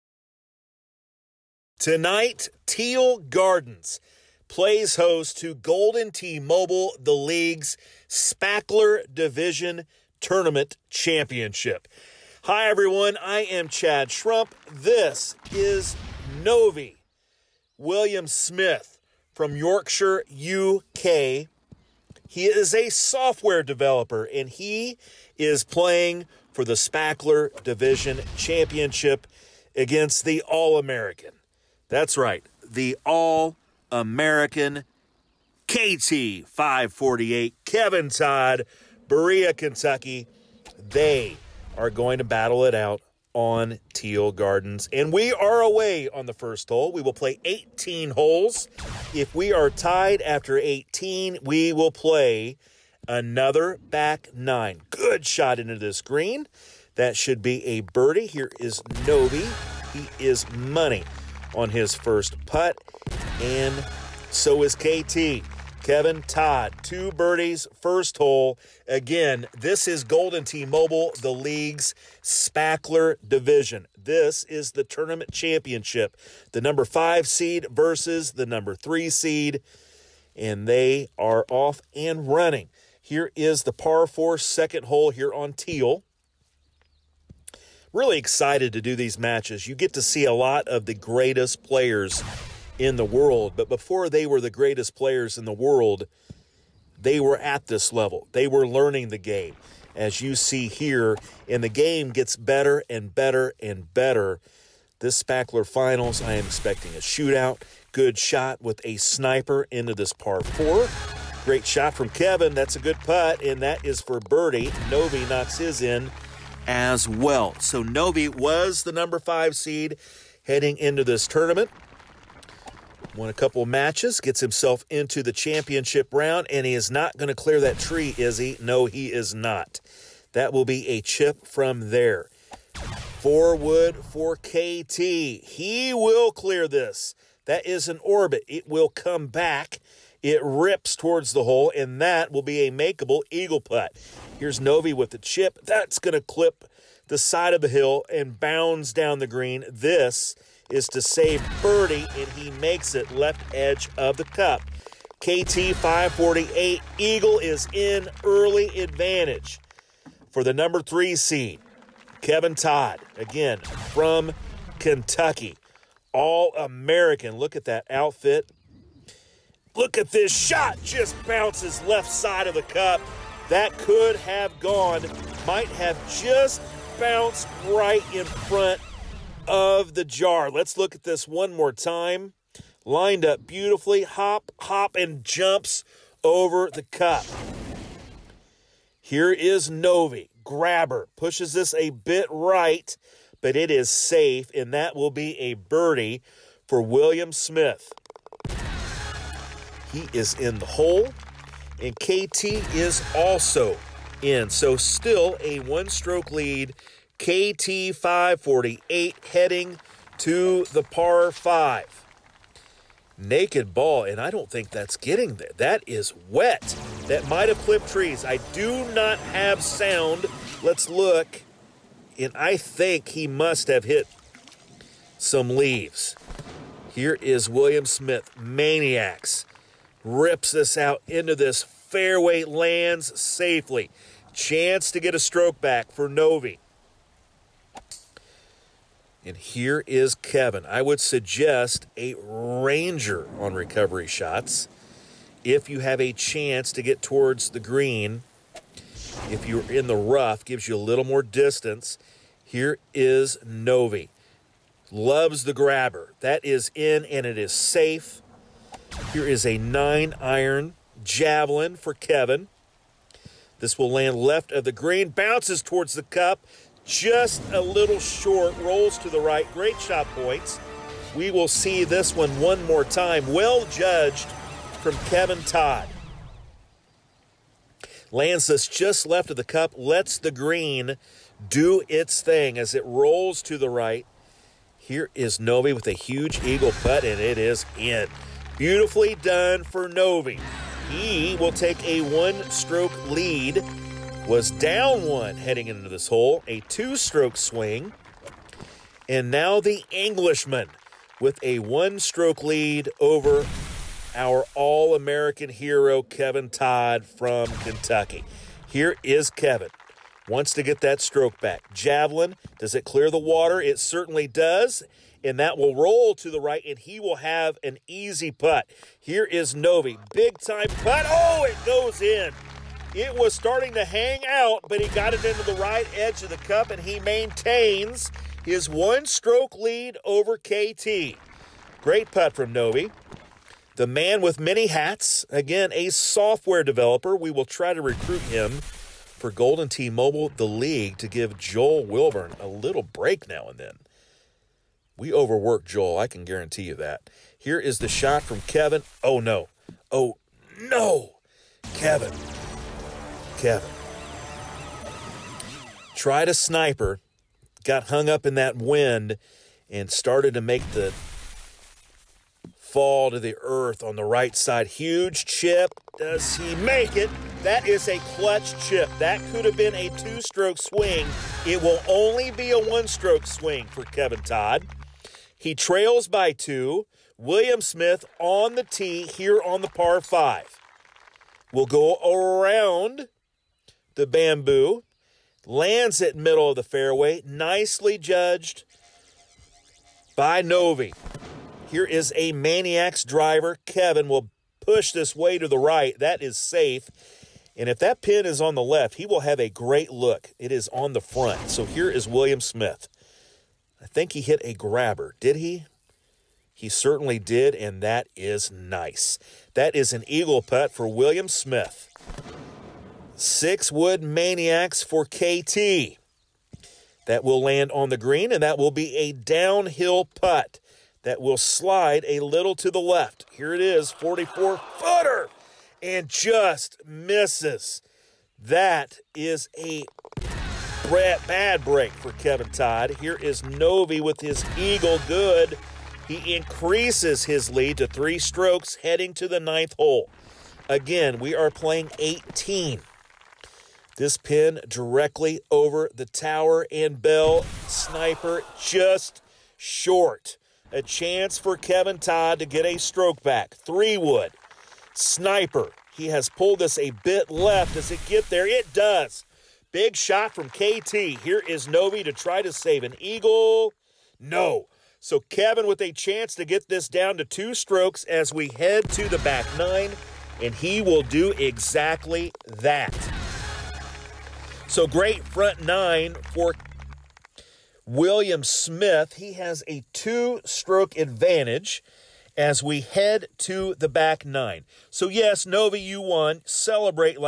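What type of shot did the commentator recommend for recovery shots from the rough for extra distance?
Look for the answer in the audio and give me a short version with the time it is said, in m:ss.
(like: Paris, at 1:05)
Ranger, at 4:02.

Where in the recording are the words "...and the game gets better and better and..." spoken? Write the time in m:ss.
1:41.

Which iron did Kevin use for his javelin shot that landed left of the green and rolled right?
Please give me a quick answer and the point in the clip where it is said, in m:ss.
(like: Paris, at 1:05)
Nine iron, at 4:19.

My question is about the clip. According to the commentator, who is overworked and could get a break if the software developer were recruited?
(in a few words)
Joel Wilburn.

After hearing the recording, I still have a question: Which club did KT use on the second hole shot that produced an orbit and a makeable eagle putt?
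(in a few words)
Four wood.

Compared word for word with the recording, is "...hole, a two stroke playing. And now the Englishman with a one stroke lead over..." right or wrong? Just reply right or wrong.
wrong.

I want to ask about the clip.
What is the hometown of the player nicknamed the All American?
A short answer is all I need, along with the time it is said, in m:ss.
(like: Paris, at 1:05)
Berea, Kentucky, at 0:39.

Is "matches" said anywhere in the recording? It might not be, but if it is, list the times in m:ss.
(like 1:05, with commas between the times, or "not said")
1:29, 2:03.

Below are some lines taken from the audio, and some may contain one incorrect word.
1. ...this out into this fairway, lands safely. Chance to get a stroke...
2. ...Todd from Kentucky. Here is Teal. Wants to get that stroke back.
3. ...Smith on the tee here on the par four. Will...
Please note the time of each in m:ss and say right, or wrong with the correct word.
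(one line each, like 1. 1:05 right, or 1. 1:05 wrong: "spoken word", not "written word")
1. 3:50 right
2. 5:06 wrong: "Kevin", not "Teal"
3. 6:17 wrong: "five", not "four".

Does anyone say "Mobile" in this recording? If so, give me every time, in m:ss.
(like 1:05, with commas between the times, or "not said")
0:06, 1:10, 5:39.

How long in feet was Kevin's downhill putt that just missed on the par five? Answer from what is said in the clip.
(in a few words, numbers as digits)
44.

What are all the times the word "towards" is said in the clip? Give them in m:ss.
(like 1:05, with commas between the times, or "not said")
2:20, 4:07, 4:25.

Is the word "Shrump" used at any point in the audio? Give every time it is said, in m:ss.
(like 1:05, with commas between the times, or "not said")
0:14.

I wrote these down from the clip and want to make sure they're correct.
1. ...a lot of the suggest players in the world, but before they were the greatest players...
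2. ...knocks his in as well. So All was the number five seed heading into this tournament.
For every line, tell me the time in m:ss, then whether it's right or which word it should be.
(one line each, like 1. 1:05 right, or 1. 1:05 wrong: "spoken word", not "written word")
1. 1:30 wrong: "greatest", not "suggest"
2. 1:55 wrong: "Novi", not "All".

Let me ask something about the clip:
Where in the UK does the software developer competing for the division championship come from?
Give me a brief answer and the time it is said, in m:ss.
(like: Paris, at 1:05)
Yorkshire, at 0:19.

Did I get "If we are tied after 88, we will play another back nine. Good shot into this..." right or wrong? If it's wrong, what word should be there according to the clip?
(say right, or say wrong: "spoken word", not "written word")
wrong: "18", not "88".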